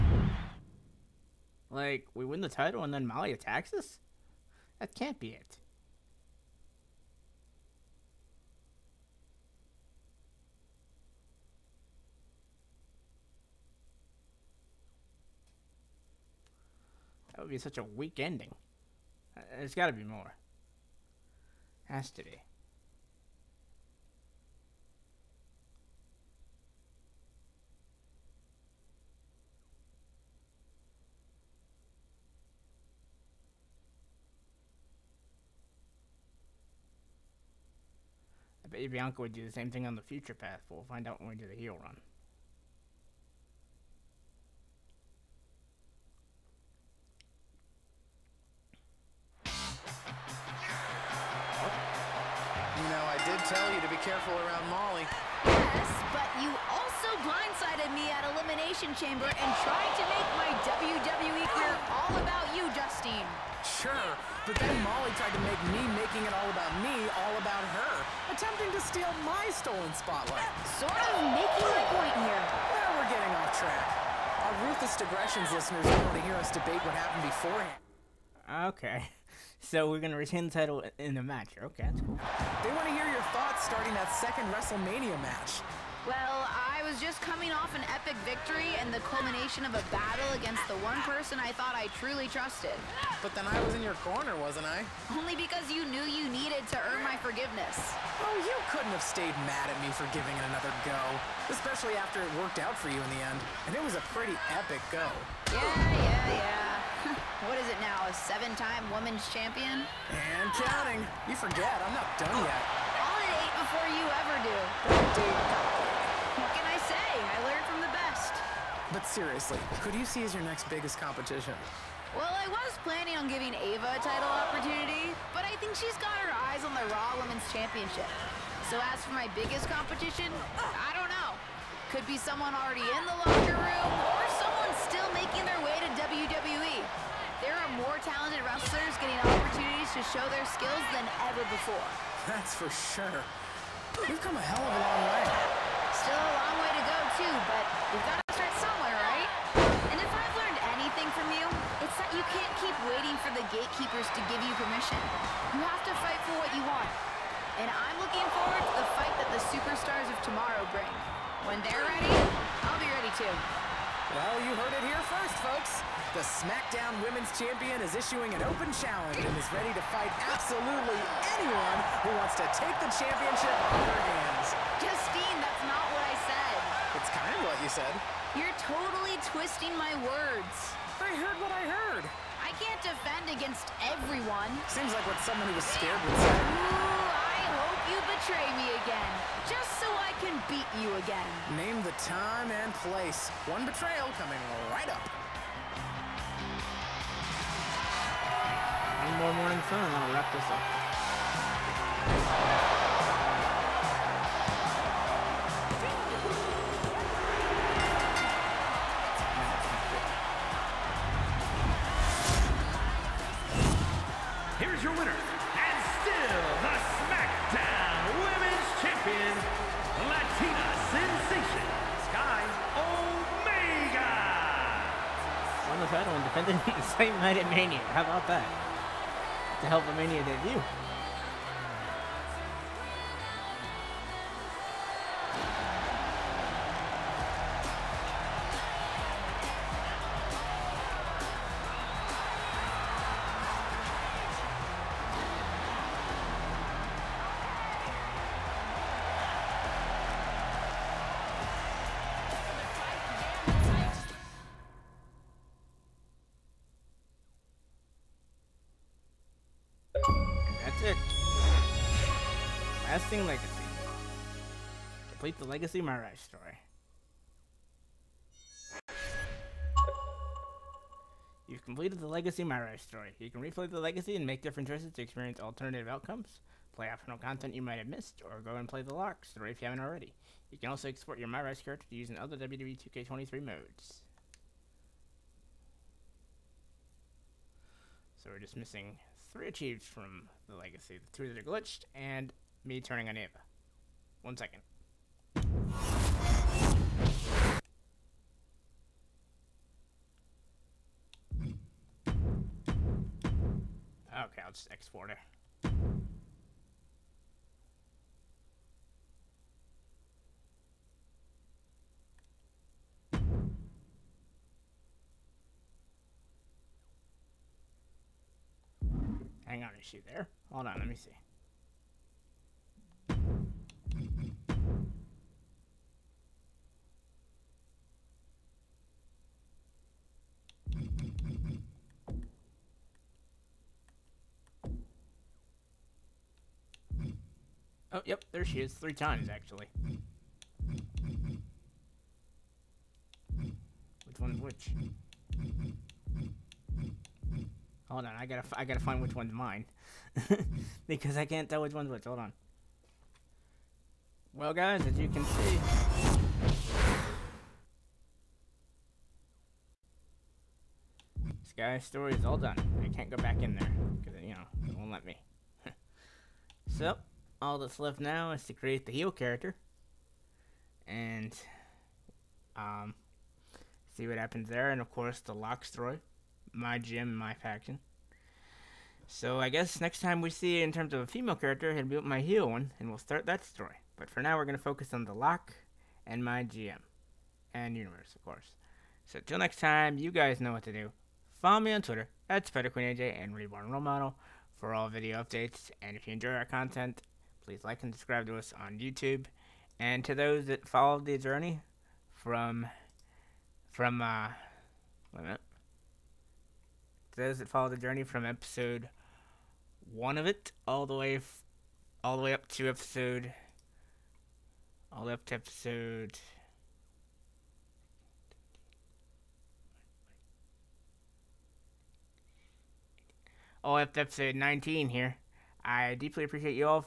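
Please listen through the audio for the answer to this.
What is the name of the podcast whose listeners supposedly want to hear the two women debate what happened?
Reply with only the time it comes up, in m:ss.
1:14.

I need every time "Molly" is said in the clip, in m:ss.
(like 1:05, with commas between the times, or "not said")
0:03, 0:54, 1:04.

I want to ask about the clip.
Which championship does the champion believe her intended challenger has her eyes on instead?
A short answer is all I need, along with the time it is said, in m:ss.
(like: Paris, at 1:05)
Raw Women's Championship, at 2:06.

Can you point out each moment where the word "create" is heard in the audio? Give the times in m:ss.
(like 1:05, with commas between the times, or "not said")
6:08.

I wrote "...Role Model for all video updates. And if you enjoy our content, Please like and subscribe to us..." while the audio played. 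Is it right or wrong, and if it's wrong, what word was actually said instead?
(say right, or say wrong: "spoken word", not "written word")
right.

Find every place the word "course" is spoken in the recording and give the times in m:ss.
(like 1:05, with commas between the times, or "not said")
6:14, 6:28.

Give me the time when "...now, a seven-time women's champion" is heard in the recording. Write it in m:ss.
1:47.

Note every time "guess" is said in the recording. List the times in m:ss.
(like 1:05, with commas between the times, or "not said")
6:19.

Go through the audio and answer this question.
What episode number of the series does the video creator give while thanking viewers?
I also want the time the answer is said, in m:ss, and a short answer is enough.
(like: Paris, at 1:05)
19, at 7:04.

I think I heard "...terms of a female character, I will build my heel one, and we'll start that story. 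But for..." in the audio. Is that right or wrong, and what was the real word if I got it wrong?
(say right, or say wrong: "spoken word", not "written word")
right.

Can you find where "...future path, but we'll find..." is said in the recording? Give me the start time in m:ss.
0:40.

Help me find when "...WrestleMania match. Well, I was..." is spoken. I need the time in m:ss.
1:24.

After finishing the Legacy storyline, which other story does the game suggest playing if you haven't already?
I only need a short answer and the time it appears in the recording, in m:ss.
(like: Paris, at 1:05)
Lark, at 4:38.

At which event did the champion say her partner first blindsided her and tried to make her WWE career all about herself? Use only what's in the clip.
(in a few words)
Elimination Chamber.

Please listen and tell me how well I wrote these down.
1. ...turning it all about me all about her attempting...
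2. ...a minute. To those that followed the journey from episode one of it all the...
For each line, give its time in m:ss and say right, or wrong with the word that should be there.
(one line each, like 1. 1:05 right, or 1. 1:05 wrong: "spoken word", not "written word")
1. 1:05 wrong: "making", not "turning"
2. 6:45 right.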